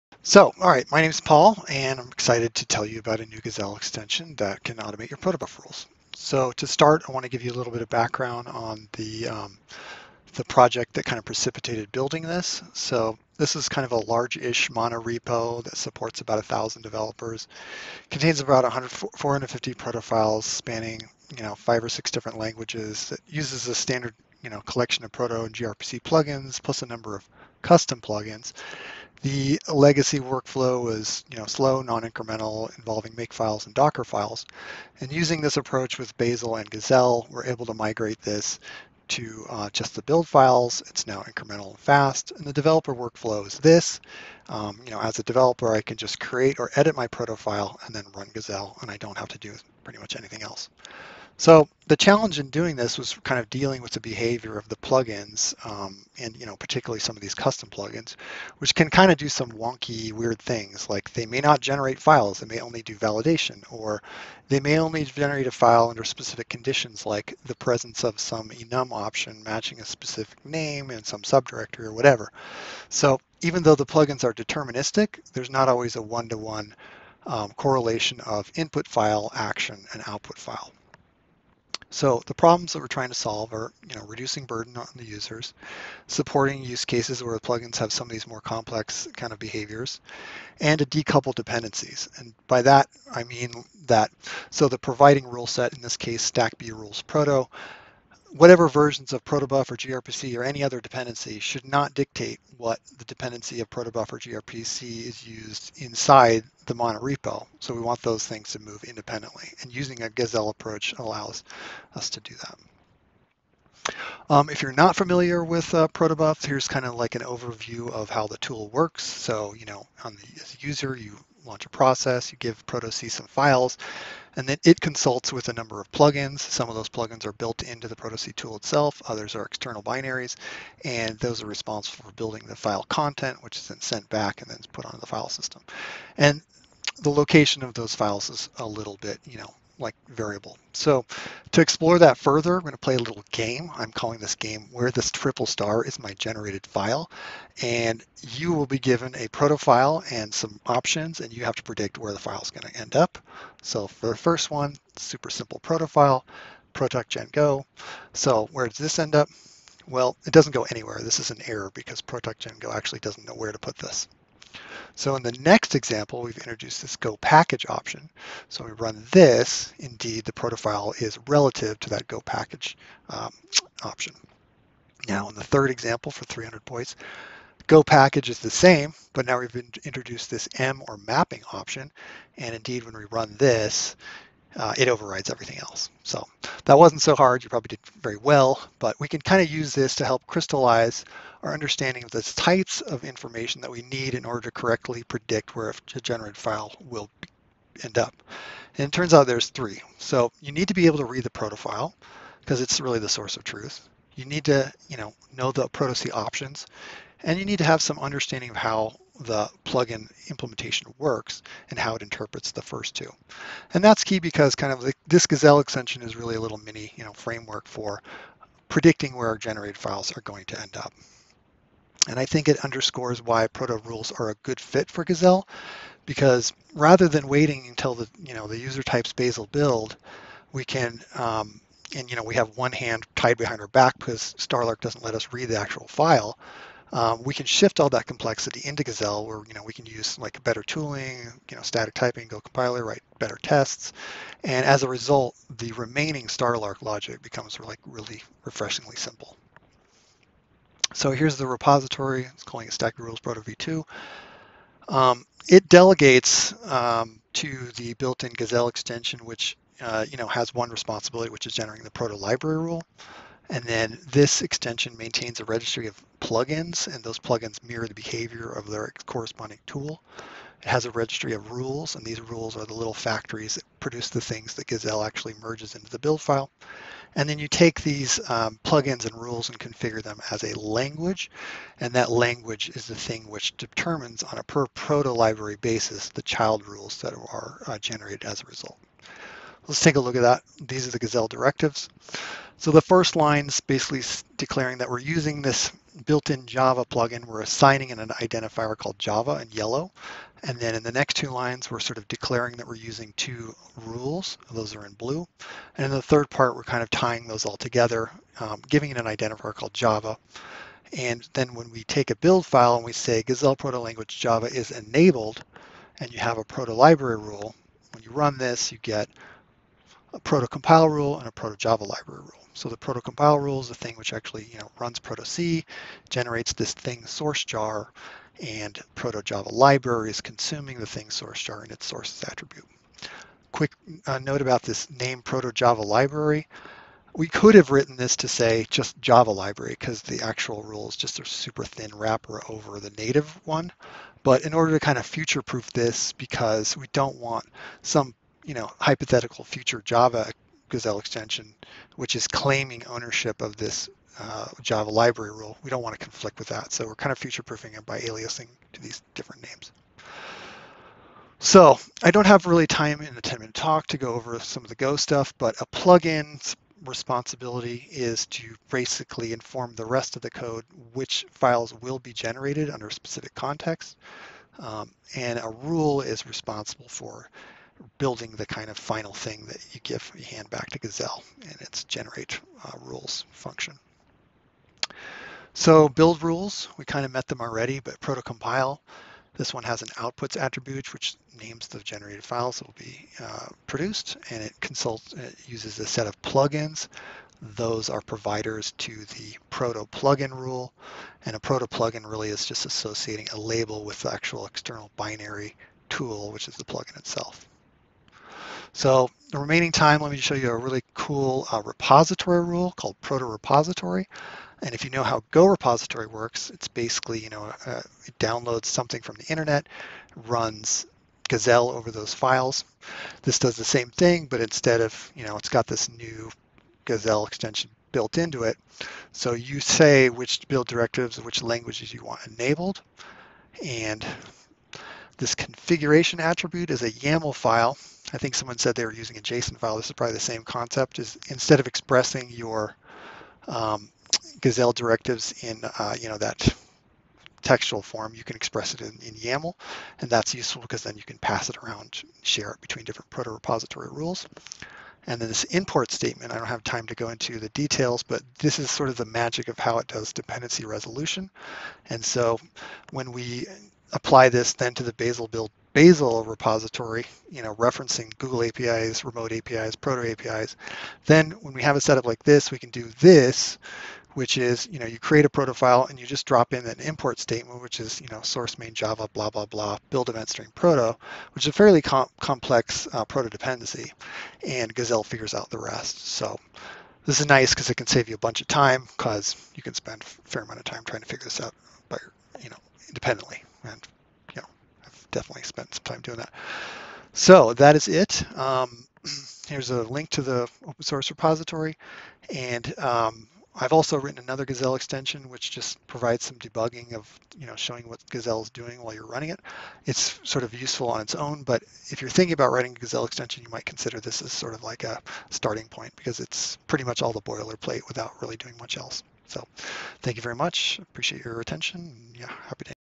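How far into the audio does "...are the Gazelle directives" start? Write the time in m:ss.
4:50.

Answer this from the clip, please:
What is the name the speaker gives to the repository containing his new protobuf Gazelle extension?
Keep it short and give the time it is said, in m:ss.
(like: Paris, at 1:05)
stack rules proto v2, at 4:12.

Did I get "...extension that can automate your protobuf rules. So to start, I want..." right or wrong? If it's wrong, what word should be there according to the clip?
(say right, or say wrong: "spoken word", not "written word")
right.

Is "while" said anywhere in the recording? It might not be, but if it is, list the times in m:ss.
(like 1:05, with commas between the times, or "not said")
8:28.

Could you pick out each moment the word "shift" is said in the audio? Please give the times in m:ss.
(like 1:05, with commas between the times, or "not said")
3:57.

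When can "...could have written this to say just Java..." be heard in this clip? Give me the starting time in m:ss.
5:37.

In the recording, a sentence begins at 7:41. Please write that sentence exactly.
And so when we apply this then to the Bazel build Bazel repository, you know, referencing Google APIs, remote APIs, proto APIs.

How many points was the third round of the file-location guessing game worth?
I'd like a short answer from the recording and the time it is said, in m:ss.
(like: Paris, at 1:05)
300, at 2:56.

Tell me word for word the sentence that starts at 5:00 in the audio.
And then in the next two lines, we're sort of declaring that we're using two rules.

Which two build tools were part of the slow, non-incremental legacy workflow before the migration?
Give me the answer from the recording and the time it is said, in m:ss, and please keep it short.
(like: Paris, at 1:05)
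Make files and Docker files, at 0:33.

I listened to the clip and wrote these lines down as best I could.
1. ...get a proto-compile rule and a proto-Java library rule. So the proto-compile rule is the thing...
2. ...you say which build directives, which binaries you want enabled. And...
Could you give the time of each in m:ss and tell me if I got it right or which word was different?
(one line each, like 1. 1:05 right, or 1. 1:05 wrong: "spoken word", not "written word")
1. 5:18 right
2. 7:09 wrong: "languages", not "binaries".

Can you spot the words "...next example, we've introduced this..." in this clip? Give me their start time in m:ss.
2:45.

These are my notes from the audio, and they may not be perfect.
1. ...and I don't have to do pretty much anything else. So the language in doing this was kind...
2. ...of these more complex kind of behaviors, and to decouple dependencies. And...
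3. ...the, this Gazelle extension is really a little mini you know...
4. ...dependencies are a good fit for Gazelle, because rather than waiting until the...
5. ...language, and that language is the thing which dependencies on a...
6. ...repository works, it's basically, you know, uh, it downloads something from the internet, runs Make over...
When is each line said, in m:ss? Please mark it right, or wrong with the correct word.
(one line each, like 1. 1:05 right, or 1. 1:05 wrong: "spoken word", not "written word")
1. 0:48 wrong: "challenge", not "language"
2. 1:28 right
3. 3:34 right
4. 3:43 wrong: "rules", not "dependencies"
5. 4:40 wrong: "determines", not "dependencies"
6. 6:55 wrong: "Gazelle", not "Make".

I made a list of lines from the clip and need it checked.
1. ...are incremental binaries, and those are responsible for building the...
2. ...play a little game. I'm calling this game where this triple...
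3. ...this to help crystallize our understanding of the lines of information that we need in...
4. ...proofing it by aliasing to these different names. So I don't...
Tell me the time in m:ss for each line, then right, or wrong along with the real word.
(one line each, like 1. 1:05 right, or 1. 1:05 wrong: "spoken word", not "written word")
1. 2:09 wrong: "external", not "incremental"
2. 2:22 right
3. 3:09 wrong: "types", not "lines"
4. 5:57 right.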